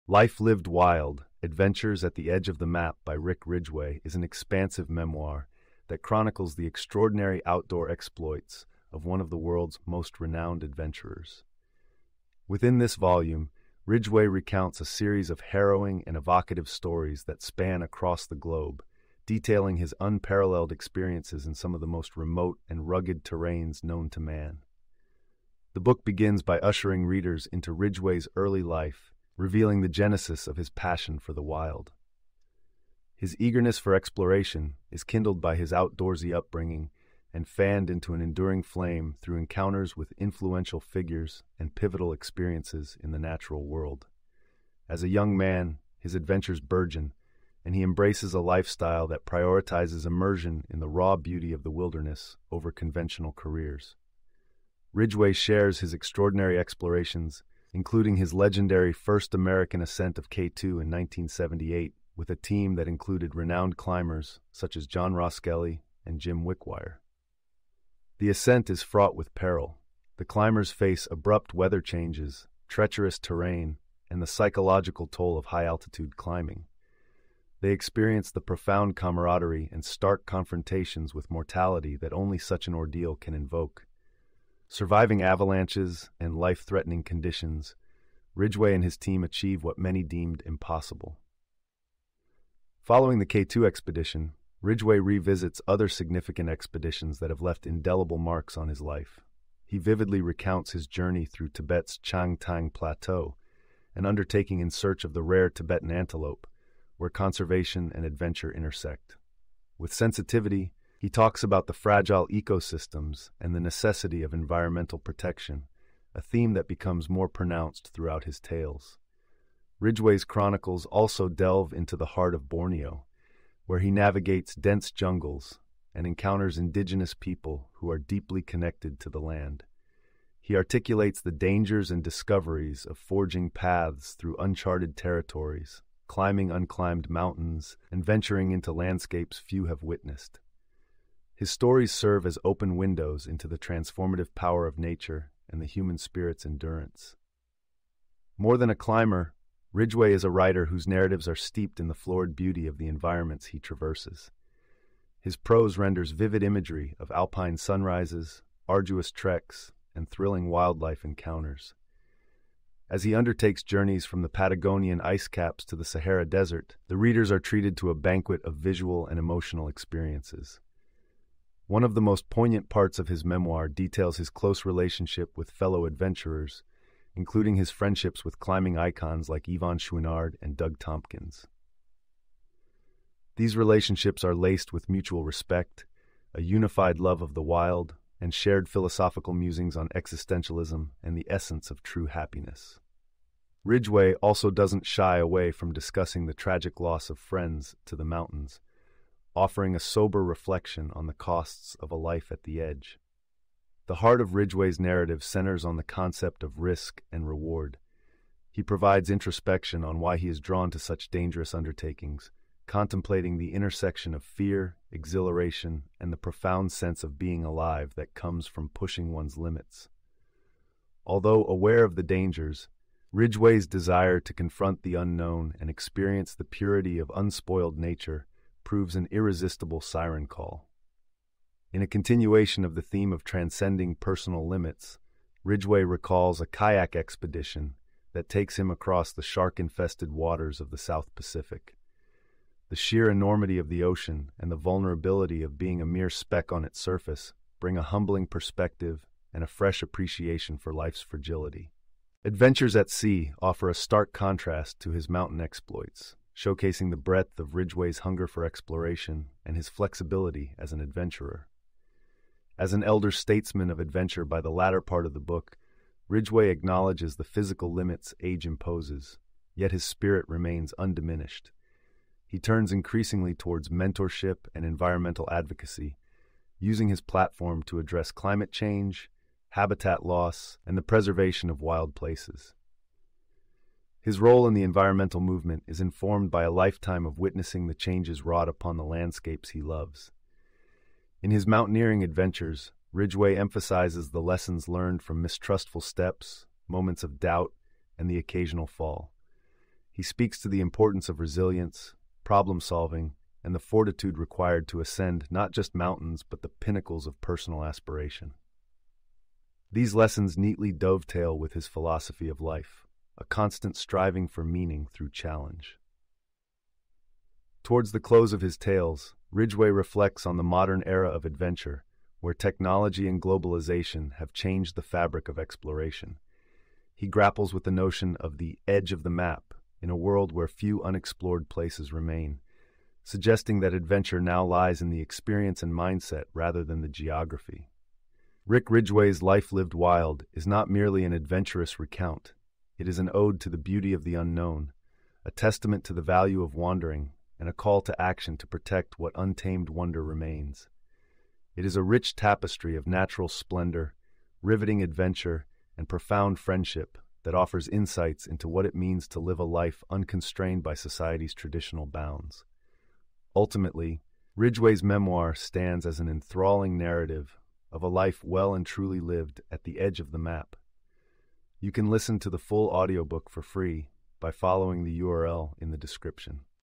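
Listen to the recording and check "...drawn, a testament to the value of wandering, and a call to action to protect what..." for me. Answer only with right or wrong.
wrong.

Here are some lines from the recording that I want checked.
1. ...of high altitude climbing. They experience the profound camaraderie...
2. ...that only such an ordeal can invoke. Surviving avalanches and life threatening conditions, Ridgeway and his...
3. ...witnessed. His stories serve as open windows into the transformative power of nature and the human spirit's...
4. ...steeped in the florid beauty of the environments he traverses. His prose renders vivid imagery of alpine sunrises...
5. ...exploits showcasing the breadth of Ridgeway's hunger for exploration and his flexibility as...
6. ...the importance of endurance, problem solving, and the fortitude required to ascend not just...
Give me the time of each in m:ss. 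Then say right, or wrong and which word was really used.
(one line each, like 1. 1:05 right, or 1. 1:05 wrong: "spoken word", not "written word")
1. 1:15 right
2. 1:21 right
3. 2:19 right
4. 2:31 right
5. 4:15 right
6. 5:00 wrong: "resilience", not "endurance".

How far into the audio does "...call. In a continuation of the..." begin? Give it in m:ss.
3:50.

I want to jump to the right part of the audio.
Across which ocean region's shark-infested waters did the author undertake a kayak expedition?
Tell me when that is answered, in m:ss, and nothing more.
4:00.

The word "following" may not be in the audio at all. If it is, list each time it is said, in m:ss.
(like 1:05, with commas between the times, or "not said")
1:32, 6:14.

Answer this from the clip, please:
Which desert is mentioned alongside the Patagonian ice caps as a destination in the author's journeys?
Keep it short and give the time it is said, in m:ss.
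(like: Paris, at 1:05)
Sahara Desert, at 2:45.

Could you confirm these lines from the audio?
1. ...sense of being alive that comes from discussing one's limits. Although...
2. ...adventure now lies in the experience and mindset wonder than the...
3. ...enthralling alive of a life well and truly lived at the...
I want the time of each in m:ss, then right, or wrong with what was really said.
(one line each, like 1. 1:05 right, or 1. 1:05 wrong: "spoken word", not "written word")
1. 3:36 wrong: "pushing", not "discussing"
2. 5:33 wrong: "rather", not "wonder"
3. 6:06 wrong: "narrative", not "alive".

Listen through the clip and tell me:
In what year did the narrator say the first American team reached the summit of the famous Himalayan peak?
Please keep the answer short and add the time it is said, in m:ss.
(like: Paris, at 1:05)
1978, at 1:00.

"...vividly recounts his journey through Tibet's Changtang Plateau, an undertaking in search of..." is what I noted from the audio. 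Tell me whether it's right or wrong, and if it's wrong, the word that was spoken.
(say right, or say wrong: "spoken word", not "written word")
right.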